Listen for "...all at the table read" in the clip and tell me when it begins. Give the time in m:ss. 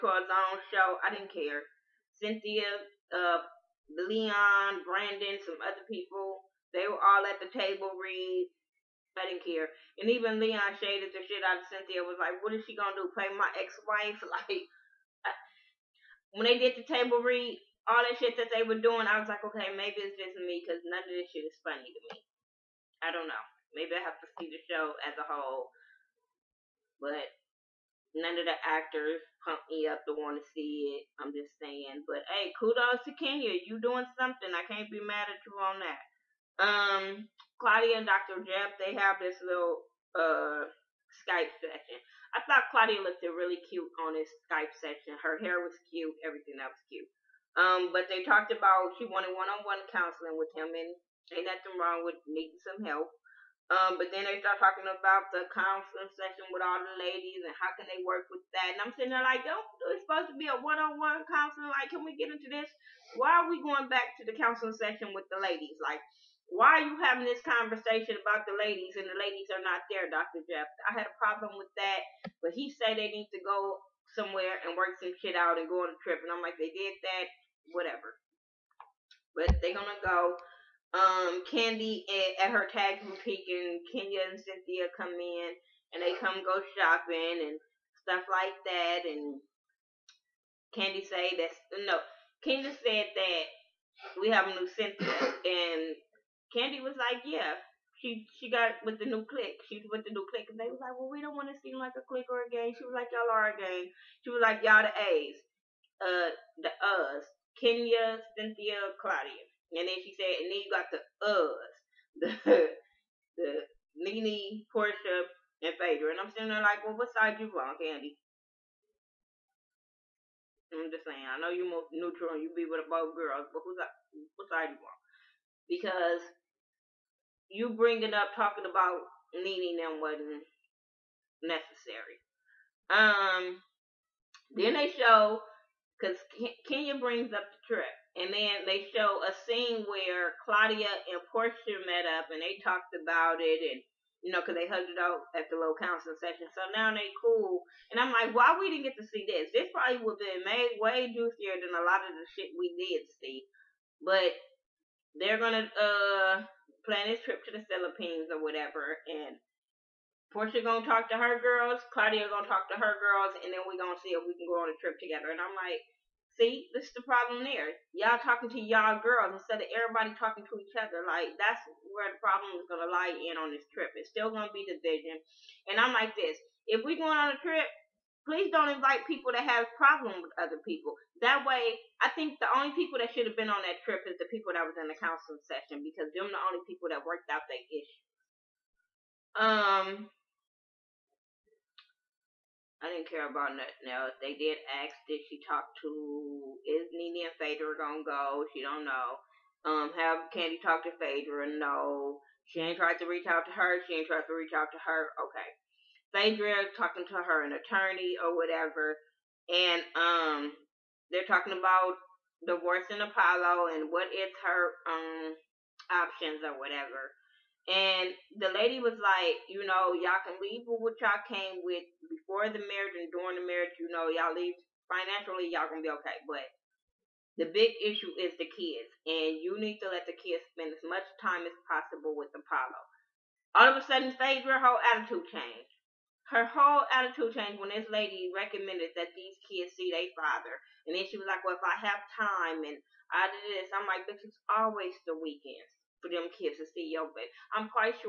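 0:07.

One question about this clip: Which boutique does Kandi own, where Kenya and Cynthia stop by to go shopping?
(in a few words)
Tag boutique.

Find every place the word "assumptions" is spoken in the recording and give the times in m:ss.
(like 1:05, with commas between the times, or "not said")
not said.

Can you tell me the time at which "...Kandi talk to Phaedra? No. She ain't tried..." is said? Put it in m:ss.
3:20.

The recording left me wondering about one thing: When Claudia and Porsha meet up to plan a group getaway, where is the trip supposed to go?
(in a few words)
The Philippines.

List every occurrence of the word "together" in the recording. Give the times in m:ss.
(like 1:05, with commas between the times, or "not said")
2:45.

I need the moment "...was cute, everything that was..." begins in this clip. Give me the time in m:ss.
0:45.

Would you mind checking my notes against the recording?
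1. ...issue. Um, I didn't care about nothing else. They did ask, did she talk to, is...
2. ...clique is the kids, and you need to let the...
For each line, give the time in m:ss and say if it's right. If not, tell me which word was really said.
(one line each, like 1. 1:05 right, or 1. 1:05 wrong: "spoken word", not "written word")
1. 3:07 right
2. 3:47 wrong: "issue", not "clique".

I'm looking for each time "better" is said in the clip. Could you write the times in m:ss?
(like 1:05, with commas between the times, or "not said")
not said.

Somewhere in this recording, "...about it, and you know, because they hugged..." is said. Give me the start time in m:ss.
2:22.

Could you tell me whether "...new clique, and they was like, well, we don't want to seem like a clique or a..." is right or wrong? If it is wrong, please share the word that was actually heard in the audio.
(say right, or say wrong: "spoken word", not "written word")
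right.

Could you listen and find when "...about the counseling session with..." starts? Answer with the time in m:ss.
0:54.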